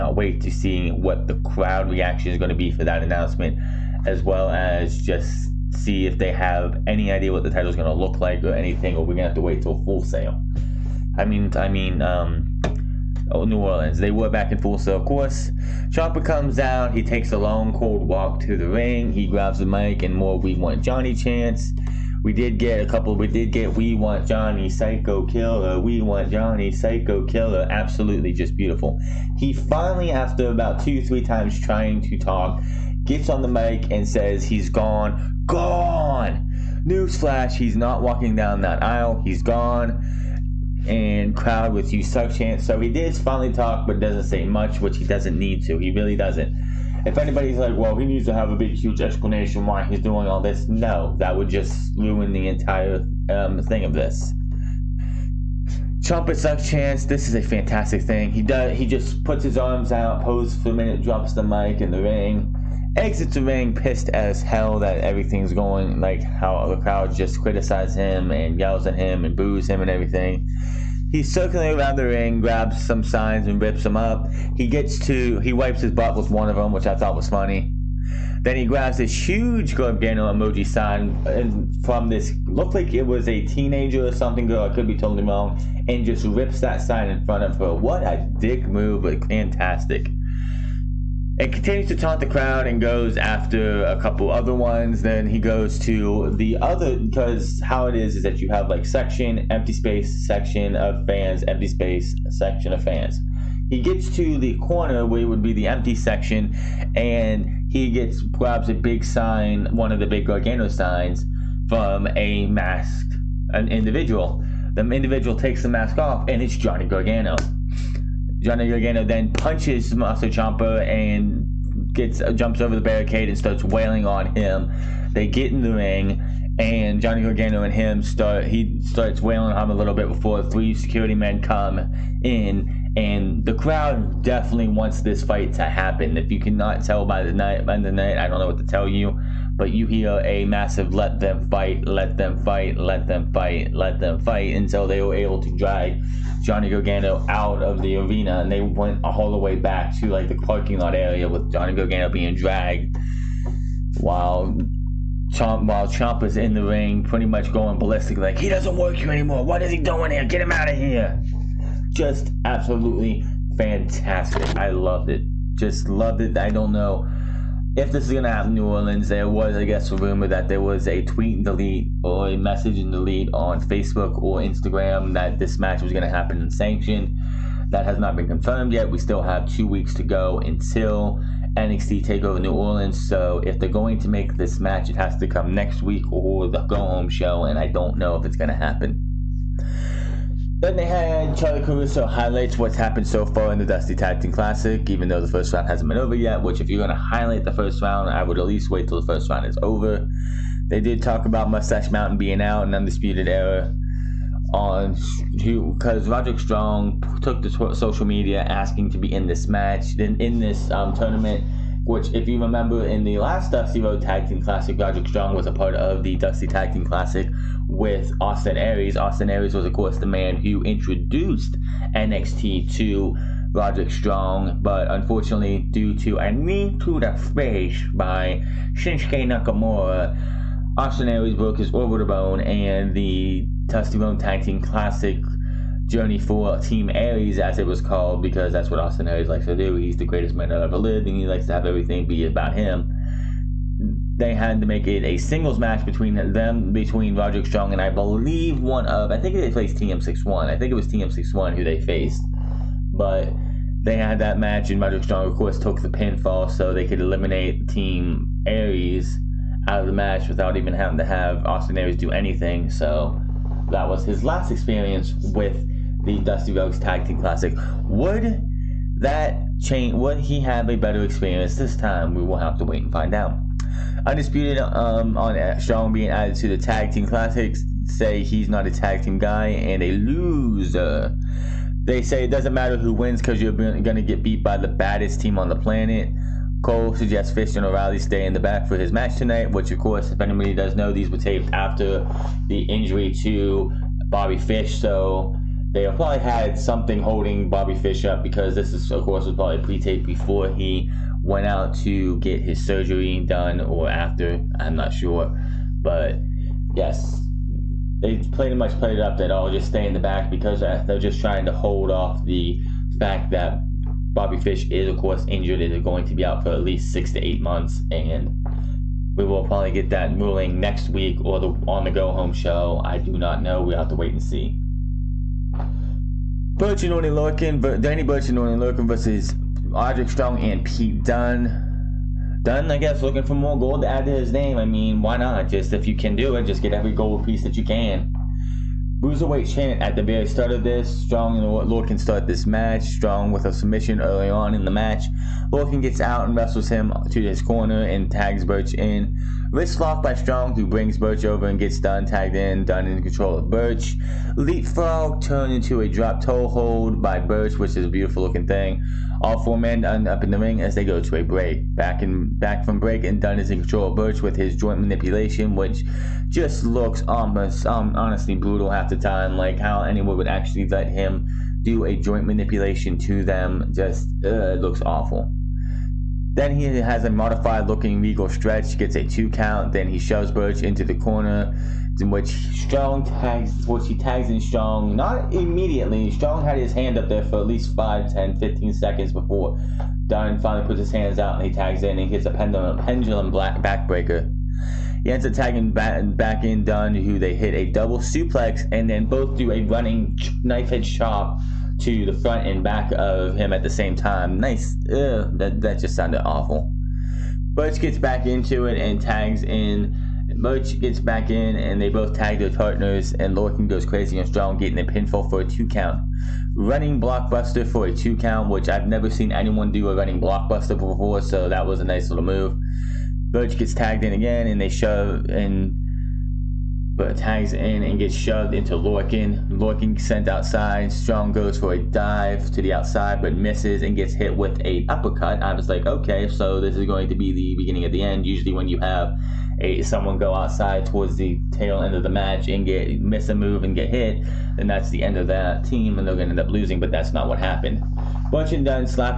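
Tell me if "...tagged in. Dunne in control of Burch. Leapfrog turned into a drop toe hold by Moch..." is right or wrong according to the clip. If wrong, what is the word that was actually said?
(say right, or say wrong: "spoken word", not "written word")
wrong: "Burch", not "Moch".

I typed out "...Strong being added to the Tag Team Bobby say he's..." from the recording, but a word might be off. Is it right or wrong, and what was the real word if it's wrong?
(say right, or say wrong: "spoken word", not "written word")
wrong: "Classics", not "Bobby".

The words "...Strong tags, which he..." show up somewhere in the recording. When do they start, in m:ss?
6:22.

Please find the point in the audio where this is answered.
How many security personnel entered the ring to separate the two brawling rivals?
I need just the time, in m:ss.
2:10.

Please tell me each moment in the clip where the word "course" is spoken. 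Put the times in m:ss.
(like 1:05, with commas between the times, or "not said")
0:15, 3:39, 4:15, 4:49, 4:59, 5:14.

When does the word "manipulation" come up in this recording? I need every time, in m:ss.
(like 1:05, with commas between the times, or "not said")
6:04, 6:12.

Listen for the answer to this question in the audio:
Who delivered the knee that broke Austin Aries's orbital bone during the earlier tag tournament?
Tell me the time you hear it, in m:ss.
3:48.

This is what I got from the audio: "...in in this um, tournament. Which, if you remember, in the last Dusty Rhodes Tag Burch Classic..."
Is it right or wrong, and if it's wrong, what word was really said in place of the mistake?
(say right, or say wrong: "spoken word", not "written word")
wrong: "Team", not "Burch".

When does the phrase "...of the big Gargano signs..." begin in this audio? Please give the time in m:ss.
1:49.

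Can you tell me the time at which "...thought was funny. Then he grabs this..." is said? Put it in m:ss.
1:16.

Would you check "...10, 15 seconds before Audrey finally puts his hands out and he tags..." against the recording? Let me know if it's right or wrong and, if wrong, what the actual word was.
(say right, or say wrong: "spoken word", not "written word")
wrong: "Dunne", not "Audrey".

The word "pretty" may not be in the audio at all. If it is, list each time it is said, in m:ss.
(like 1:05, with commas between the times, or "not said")
2:37, 5:08.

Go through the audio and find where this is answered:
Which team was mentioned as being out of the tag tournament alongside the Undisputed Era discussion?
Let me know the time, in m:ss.
3:21.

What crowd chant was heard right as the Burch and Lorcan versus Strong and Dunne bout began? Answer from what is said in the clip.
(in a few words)
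Bruiserweight.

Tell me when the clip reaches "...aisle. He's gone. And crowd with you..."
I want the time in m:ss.
0:38.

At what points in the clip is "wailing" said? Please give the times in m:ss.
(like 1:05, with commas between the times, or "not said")
2:03, 2:09.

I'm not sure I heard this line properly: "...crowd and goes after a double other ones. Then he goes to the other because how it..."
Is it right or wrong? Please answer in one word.
wrong.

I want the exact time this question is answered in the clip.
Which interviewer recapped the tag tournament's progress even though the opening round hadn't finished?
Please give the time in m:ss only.
3:11.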